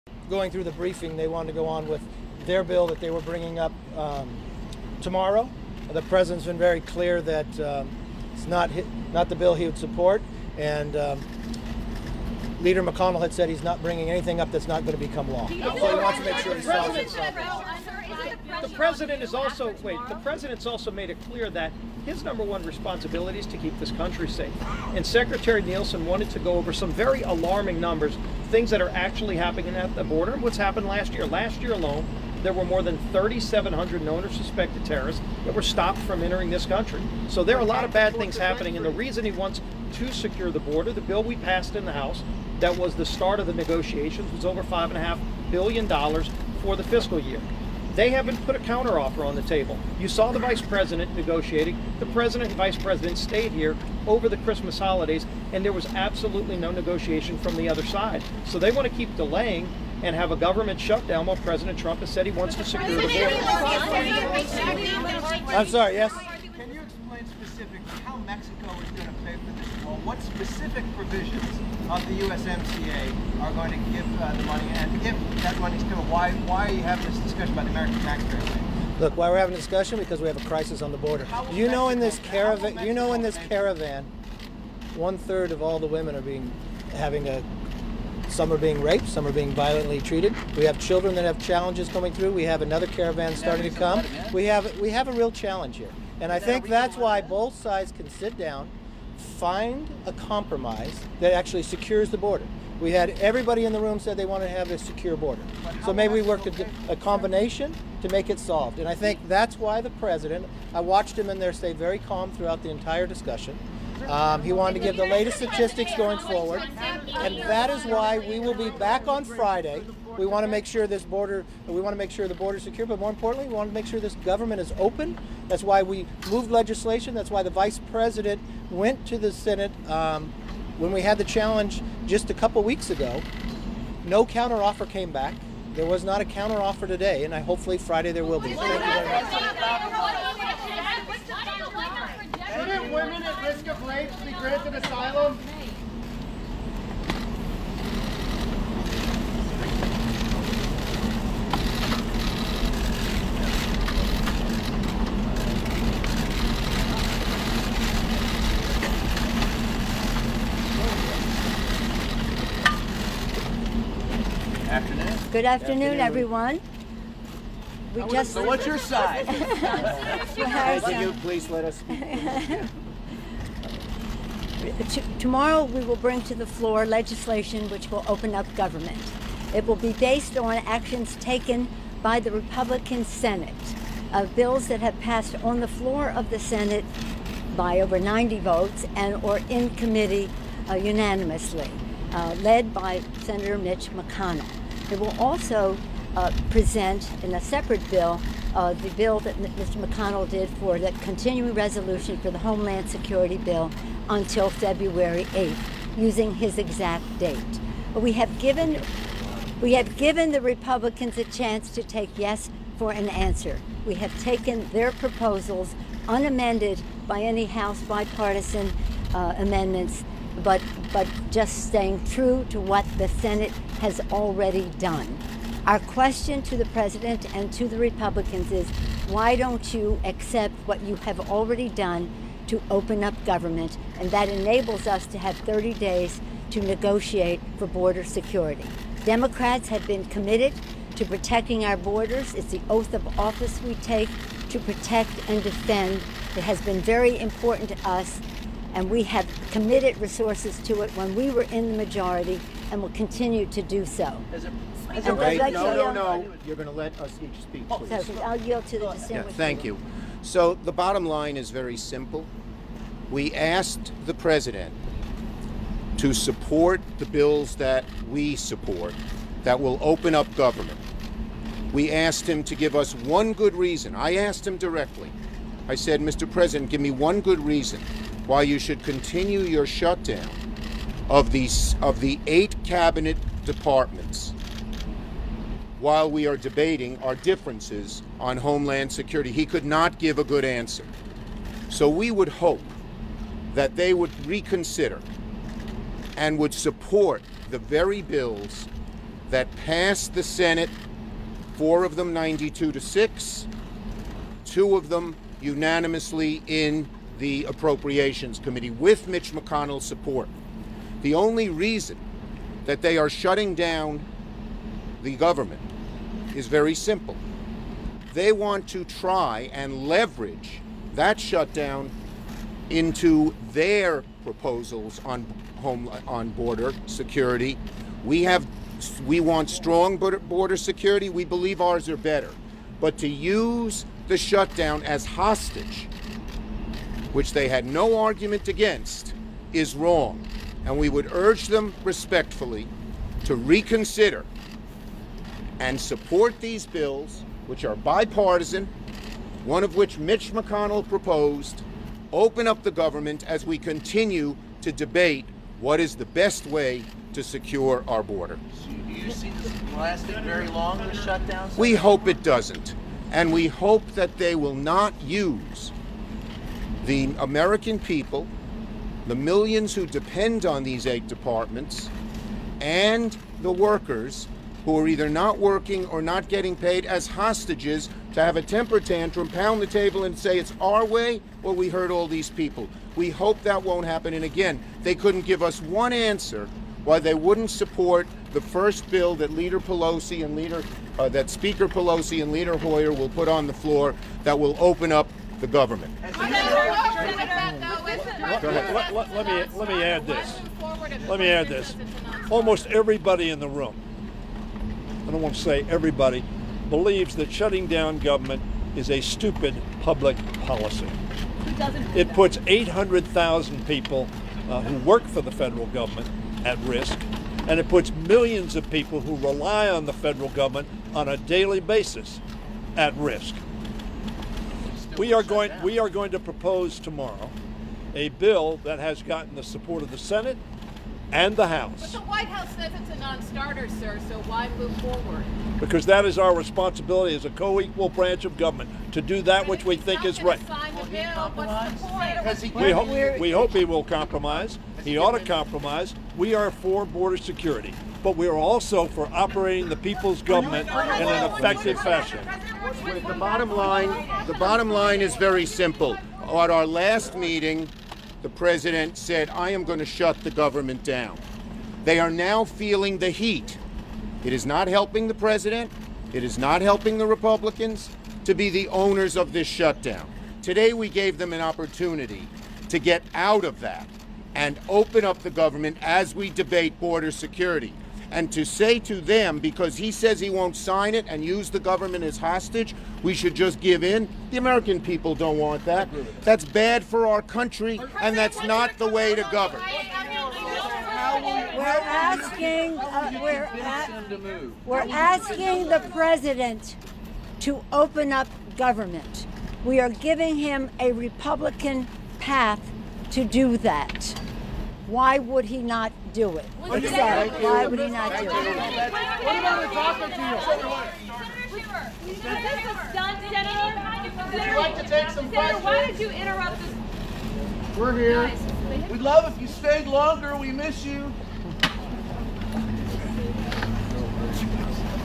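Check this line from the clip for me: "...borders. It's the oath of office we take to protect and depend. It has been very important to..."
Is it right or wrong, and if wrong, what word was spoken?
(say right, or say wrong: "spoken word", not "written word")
wrong: "defend", not "depend".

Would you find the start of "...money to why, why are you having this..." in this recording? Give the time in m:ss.
1:15.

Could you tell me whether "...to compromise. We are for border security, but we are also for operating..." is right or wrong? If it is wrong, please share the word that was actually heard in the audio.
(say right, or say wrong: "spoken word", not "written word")
right.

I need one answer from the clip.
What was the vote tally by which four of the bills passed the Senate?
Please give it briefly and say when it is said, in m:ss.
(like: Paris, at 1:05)
92 to 6, at 5:02.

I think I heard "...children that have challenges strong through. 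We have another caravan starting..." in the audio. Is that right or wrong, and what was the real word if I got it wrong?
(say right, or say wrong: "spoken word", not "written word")
wrong: "coming", not "strong".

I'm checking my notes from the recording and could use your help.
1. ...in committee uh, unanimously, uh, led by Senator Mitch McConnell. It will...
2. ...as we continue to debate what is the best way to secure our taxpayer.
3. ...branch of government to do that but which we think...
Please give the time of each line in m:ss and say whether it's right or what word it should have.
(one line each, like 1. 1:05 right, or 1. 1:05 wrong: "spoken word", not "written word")
1. 3:09 right
2. 5:53 wrong: "border", not "taxpayer"
3. 7:17 right.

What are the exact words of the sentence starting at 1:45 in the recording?
So maybe we worked a, a, combination to make it solved.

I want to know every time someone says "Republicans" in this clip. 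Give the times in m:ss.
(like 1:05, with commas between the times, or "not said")
3:02, 3:30, 3:47, 7:47, 8:20.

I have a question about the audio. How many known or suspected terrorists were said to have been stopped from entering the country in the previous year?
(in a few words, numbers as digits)
more than 3,700.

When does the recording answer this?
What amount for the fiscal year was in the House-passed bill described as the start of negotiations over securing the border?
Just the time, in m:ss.
0:44.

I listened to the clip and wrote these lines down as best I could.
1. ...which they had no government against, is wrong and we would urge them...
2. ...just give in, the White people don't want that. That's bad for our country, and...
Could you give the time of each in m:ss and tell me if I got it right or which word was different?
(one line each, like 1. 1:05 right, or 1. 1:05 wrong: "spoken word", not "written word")
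1. 5:37 wrong: "argument", not "government"
2. 8:03 wrong: "American", not "White".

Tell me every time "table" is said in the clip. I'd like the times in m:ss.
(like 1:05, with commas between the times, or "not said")
0:49, 6:19.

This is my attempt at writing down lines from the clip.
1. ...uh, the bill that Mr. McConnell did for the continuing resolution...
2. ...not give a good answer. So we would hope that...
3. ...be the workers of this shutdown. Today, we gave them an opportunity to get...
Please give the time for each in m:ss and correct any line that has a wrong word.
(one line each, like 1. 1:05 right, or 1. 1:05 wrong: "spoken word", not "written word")
1. 3:18 right
2. 4:49 right
3. 7:48 wrong: "owners", not "workers".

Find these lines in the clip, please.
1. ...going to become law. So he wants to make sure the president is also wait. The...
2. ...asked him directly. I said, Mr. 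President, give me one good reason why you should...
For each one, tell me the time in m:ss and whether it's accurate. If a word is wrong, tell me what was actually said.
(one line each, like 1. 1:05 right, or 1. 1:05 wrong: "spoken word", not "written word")
1. 0:14 right
2. 4:34 right.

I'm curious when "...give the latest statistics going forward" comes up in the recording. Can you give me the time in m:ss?
1:54.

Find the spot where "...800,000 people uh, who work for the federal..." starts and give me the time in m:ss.
6:52.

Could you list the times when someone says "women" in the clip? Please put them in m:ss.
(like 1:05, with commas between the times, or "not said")
1:25, 2:22.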